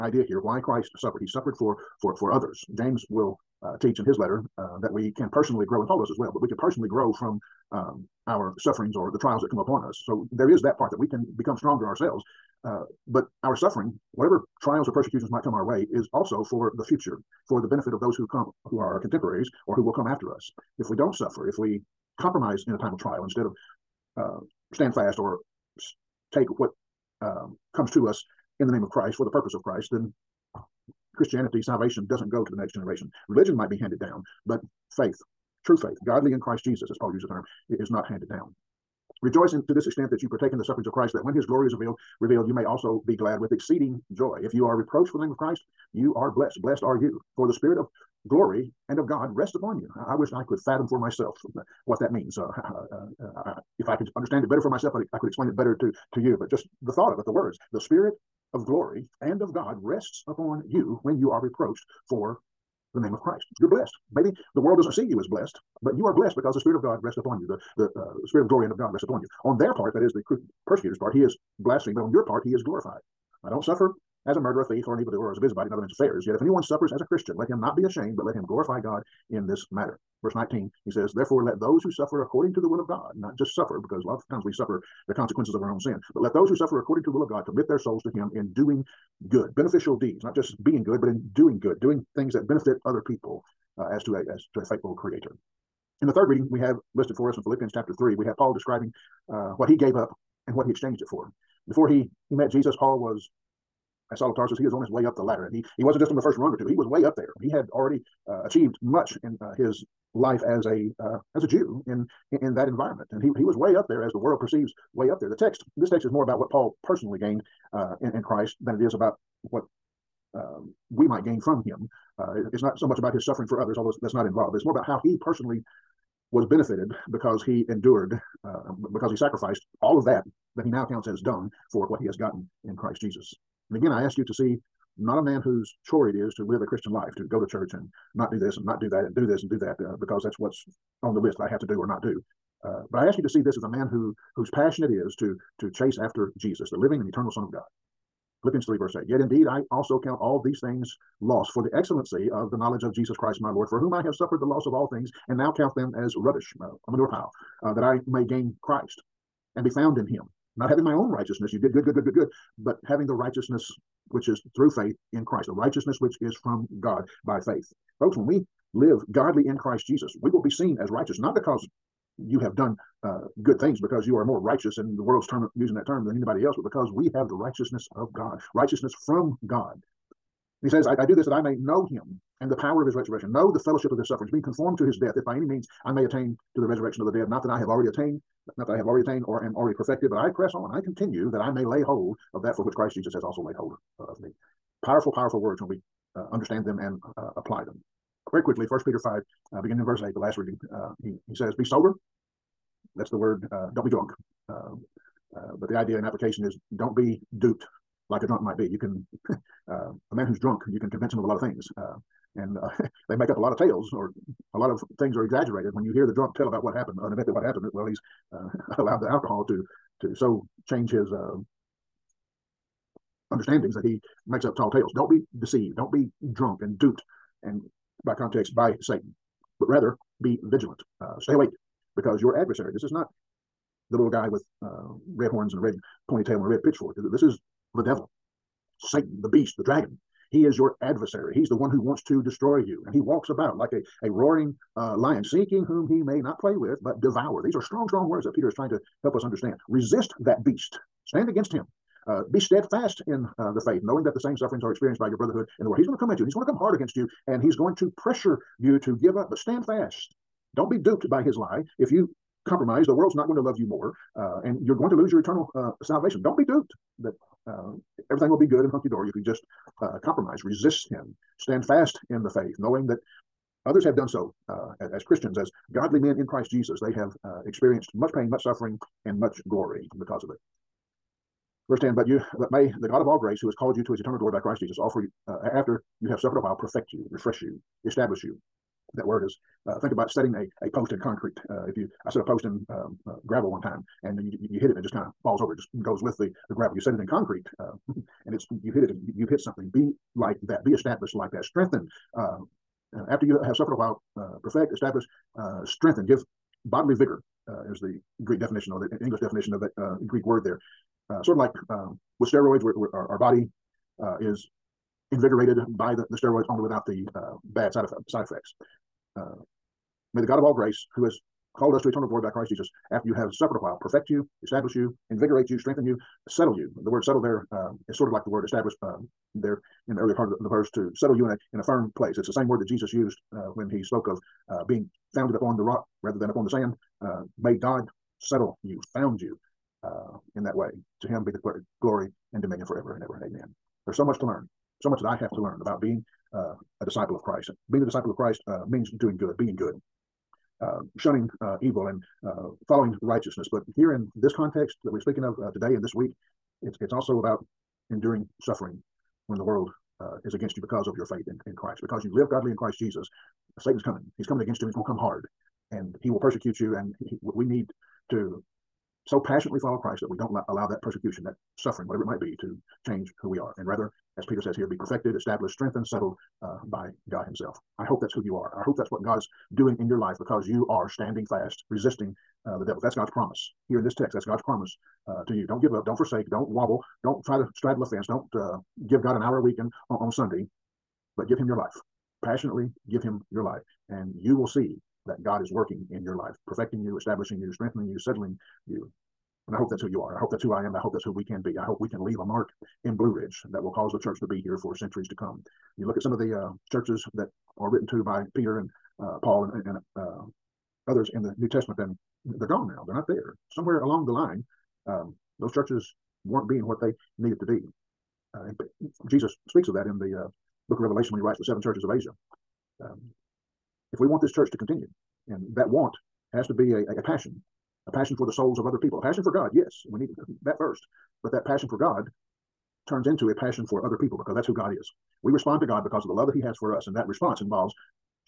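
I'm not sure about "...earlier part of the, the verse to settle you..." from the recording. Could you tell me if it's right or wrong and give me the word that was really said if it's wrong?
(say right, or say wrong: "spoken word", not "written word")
right.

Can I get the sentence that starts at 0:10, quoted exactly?
So there is that part that we can become stronger ourselves.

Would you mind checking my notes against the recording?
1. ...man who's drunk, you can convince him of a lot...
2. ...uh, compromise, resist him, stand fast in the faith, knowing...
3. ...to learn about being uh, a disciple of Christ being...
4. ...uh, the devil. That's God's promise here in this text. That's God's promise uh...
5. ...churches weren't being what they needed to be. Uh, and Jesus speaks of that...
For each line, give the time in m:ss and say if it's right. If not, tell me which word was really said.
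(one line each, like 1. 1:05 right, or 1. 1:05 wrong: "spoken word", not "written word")
1. 3:30 right
2. 4:29 right
3. 5:45 right
4. 6:22 right
5. 6:55 right.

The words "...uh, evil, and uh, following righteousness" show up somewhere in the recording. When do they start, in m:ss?
5:51.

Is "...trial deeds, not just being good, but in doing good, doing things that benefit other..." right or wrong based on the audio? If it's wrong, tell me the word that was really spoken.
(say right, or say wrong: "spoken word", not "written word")
wrong: "beneficial", not "trial".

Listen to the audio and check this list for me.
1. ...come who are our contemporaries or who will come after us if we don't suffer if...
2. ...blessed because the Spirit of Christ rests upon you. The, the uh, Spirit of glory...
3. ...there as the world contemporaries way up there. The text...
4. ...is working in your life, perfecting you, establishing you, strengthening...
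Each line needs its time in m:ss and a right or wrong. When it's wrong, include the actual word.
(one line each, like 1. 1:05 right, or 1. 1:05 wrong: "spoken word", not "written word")
1. 0:18 right
2. 1:06 wrong: "God", not "Christ"
3. 1:53 wrong: "perceives", not "contemporaries"
4. 6:35 right.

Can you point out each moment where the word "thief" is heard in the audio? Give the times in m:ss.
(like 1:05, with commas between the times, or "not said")
1:14.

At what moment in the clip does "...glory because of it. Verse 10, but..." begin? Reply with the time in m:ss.
4:39.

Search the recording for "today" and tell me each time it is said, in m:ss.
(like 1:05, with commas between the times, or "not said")
5:55.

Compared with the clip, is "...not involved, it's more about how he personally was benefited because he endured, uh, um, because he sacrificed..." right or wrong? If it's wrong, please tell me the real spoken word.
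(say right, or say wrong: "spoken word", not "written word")
right.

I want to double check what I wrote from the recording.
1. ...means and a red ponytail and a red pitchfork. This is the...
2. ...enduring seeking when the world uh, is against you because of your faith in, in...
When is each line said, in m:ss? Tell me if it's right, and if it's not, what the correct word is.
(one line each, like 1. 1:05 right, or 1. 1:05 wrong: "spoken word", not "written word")
1. 3:55 wrong: "horns", not "means"
2. 5:57 wrong: "suffering", not "seeking".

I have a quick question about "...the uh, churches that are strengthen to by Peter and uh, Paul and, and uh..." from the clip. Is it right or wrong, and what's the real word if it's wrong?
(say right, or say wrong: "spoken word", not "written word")
wrong: "written", not "strengthen".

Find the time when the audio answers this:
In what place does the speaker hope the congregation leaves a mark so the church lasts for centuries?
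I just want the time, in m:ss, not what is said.
6:42.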